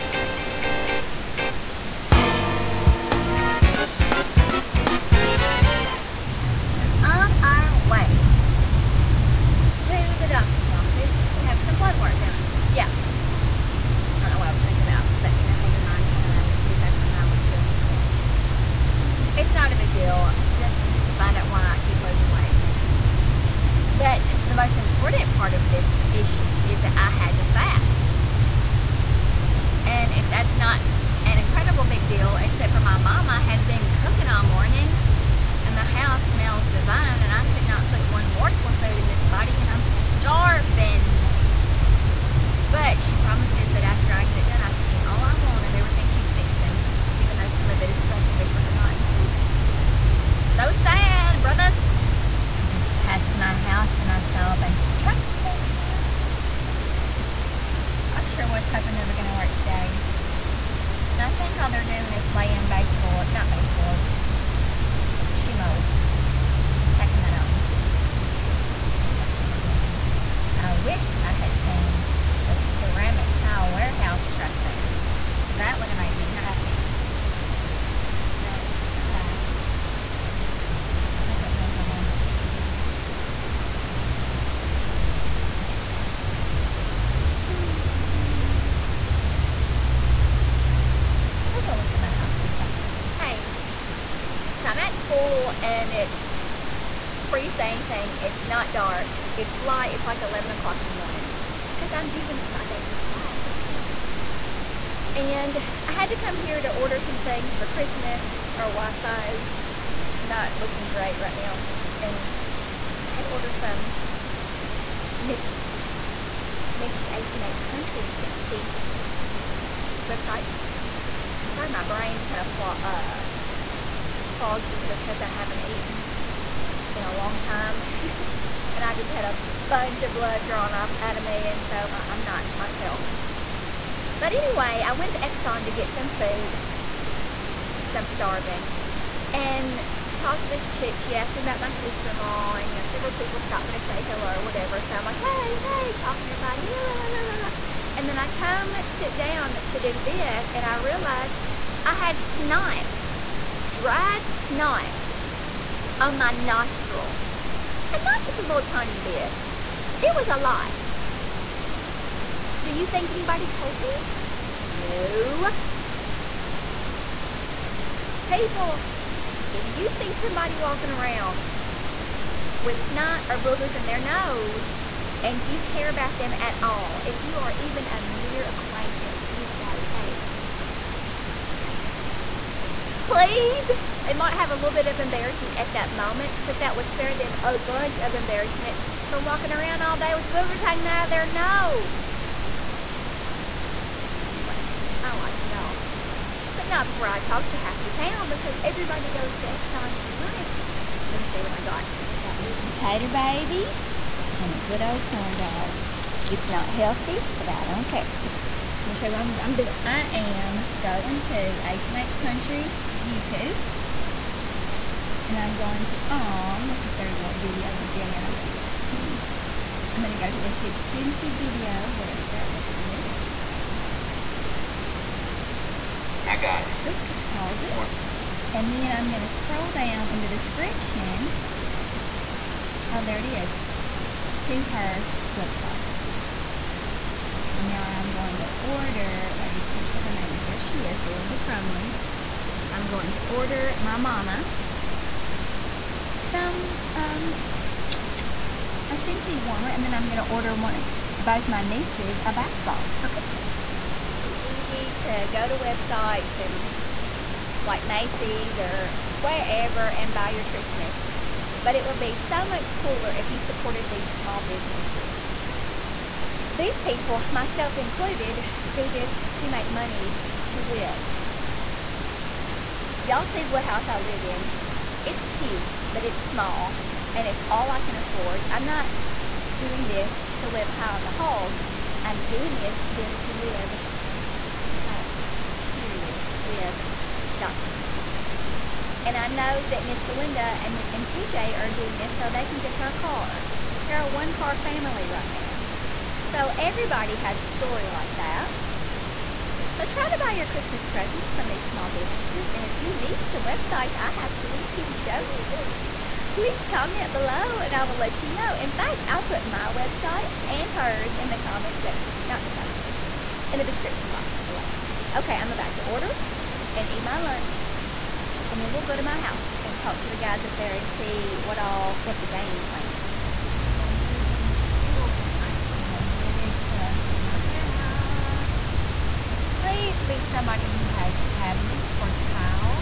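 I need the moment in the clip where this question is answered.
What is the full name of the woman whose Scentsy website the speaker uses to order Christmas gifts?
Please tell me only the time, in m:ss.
4:00.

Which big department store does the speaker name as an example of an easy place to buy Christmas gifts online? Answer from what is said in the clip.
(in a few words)
Macy's.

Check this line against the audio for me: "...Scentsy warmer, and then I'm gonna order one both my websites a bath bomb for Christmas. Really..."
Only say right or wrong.
wrong.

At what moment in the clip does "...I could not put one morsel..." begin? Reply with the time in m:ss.
0:37.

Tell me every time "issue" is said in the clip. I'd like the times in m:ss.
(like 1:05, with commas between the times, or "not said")
0:26.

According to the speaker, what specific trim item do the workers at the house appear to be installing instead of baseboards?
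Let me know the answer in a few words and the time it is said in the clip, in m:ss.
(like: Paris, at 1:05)
Shoe mold, at 1:05.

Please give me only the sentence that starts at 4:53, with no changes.
They're a one car family right now.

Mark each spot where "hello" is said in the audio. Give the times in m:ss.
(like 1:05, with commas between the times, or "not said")
2:24.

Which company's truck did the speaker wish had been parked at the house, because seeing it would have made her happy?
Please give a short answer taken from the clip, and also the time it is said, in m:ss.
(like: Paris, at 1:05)
Ceramic tile warehouse, at 1:12.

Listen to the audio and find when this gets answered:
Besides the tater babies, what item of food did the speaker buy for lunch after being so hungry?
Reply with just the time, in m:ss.
3:25.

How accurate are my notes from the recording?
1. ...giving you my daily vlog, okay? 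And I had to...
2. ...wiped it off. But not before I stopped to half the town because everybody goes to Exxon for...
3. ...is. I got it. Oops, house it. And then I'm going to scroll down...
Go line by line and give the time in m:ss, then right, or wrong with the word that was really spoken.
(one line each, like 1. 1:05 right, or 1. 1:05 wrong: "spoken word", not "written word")
1. 1:42 right
2. 3:15 wrong: "talked", not "stopped"
3. 3:42 wrong: "pause", not "house".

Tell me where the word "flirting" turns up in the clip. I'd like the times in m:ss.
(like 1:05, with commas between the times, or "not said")
not said.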